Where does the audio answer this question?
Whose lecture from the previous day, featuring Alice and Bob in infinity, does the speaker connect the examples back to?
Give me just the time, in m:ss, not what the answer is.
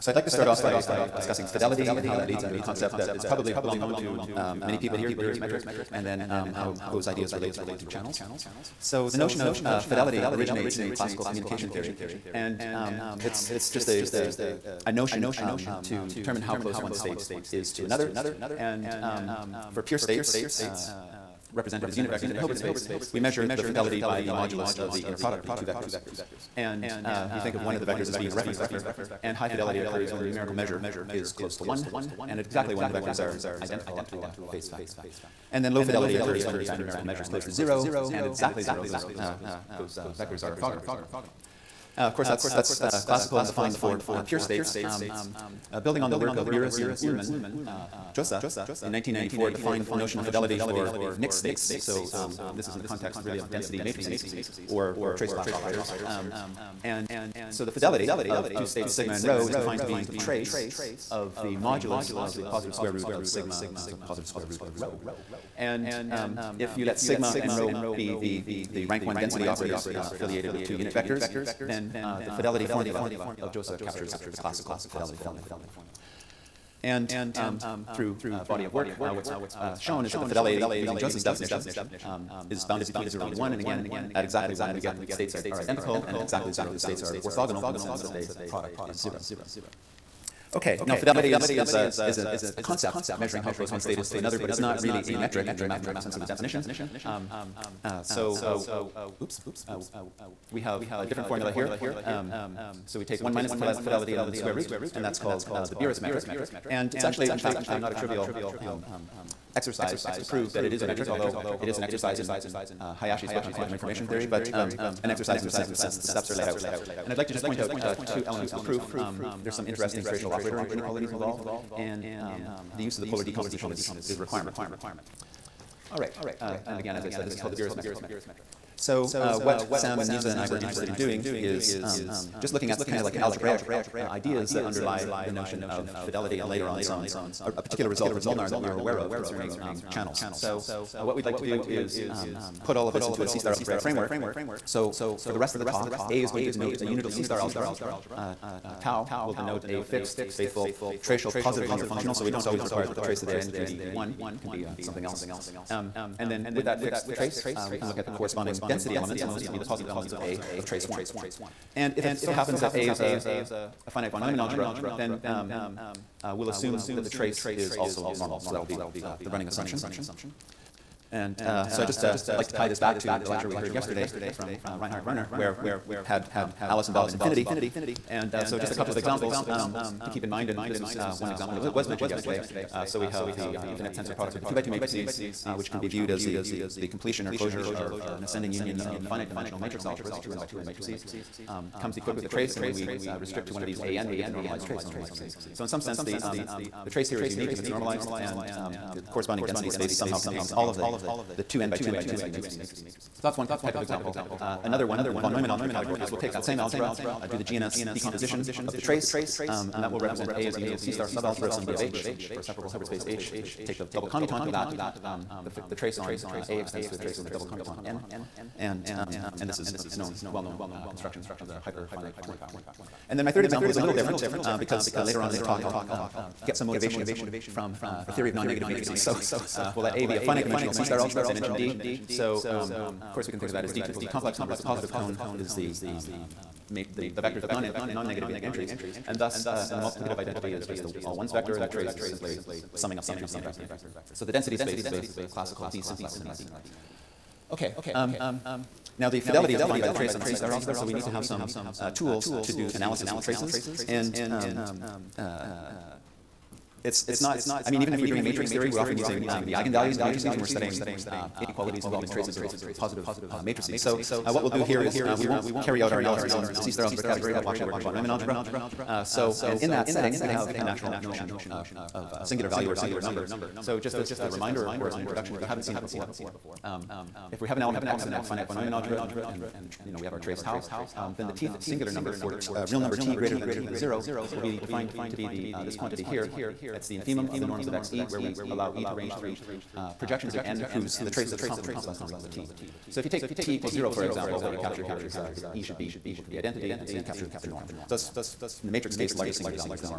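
2:54.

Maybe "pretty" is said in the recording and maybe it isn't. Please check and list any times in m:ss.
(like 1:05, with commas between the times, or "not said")
not said.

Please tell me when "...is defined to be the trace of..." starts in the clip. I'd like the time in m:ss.
0:59.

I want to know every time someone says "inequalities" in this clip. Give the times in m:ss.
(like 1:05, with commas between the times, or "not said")
2:00, 4:21.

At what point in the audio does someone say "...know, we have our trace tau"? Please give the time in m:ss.
4:39.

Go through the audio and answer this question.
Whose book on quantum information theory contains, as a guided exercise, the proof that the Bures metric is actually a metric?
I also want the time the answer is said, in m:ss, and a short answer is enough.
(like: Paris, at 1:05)
Hayashi, at 1:53.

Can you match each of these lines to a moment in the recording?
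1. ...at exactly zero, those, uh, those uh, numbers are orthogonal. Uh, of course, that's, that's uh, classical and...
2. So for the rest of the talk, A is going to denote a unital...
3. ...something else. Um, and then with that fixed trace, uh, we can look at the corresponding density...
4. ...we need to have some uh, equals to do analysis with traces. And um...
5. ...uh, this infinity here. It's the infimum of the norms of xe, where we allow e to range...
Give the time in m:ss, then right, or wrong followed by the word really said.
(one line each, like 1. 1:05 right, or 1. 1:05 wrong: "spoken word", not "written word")
1. 0:38 wrong: "vectors", not "numbers"
2. 2:24 right
3. 2:34 right
4. 4:10 wrong: "tools", not "equals"
5. 4:45 wrong: "quantity", not "infinity".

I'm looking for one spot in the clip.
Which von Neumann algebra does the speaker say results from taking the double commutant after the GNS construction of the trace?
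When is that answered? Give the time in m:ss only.
3:41.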